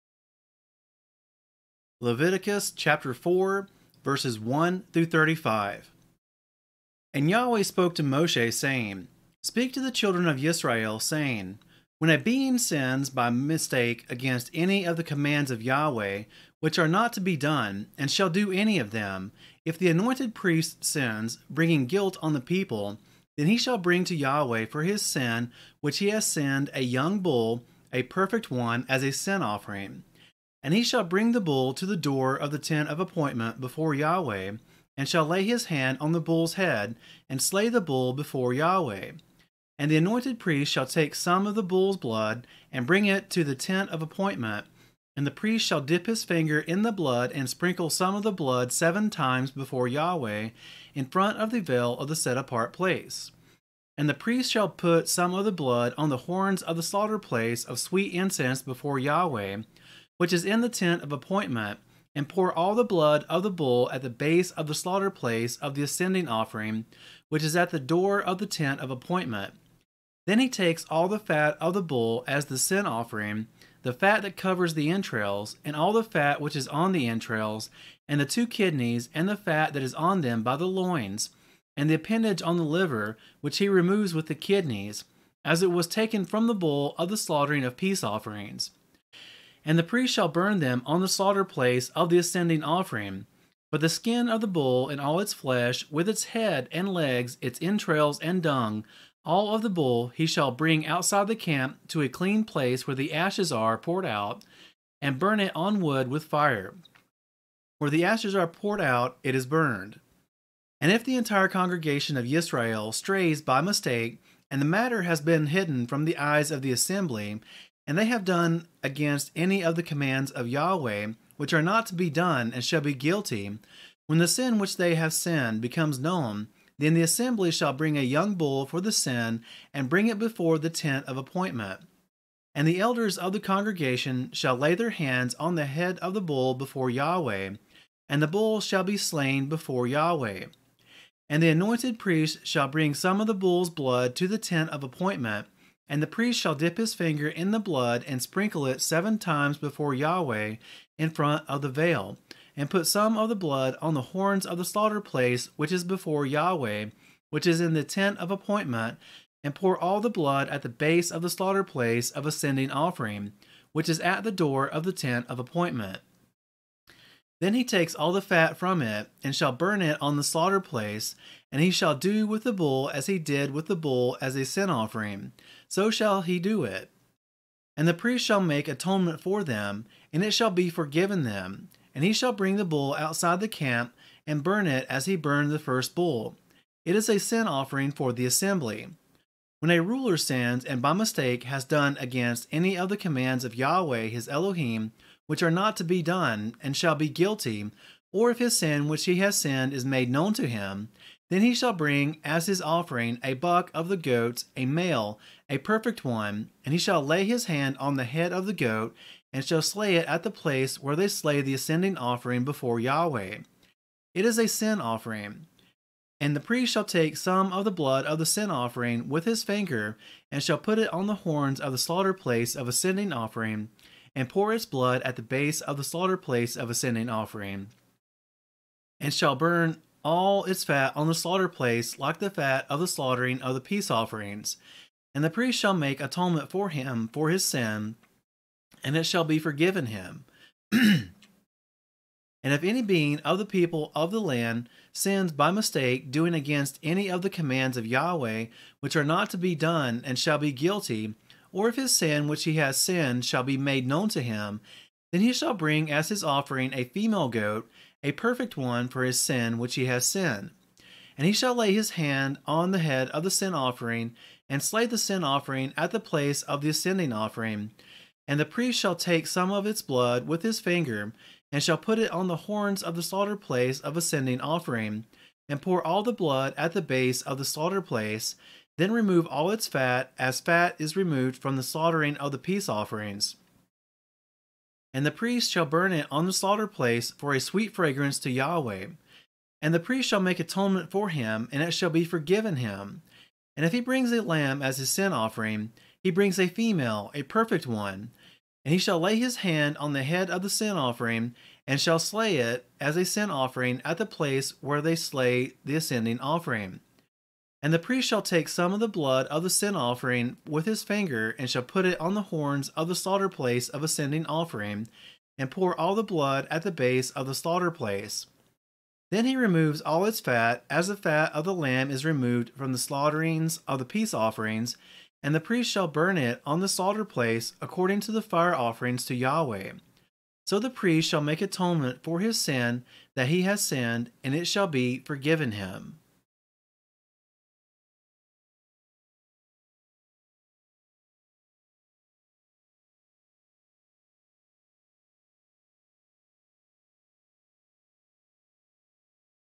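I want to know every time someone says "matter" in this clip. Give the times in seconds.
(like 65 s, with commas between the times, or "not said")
114 s.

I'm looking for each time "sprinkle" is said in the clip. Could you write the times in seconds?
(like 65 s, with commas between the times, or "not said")
47 s, 148 s.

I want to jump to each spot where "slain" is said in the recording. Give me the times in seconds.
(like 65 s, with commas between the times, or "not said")
138 s.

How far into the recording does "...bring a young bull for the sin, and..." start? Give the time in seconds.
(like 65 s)
127 s.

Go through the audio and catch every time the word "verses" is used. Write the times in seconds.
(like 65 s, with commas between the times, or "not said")
4 s.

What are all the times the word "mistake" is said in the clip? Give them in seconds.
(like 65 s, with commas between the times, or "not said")
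13 s, 113 s, 190 s, 245 s.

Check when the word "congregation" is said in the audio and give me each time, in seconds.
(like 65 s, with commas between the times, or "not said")
111 s, 133 s.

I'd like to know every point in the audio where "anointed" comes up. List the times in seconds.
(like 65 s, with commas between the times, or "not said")
19 s, 39 s, 141 s.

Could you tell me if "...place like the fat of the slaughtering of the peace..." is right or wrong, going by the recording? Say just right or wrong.
right.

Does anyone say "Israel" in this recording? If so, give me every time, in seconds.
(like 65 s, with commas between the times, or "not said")
10 s, 112 s.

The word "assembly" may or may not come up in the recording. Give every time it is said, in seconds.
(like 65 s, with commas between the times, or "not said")
116 s, 127 s, 188 s.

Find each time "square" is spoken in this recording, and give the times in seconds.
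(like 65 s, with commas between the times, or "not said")
not said.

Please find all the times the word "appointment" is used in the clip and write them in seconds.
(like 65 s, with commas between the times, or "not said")
32 s, 44 s, 61 s, 68 s, 131 s, 144 s, 158 s, 165 s.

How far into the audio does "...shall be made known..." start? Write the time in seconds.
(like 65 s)
253 s.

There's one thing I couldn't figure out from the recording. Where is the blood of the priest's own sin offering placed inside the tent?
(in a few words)
slaughter place of sweet incense.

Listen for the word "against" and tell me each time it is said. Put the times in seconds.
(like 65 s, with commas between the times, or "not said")
14 s, 118 s, 191 s, 246 s.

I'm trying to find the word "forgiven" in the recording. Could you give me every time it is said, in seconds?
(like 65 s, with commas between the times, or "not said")
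180 s, 239 s, 292 s, 334 s.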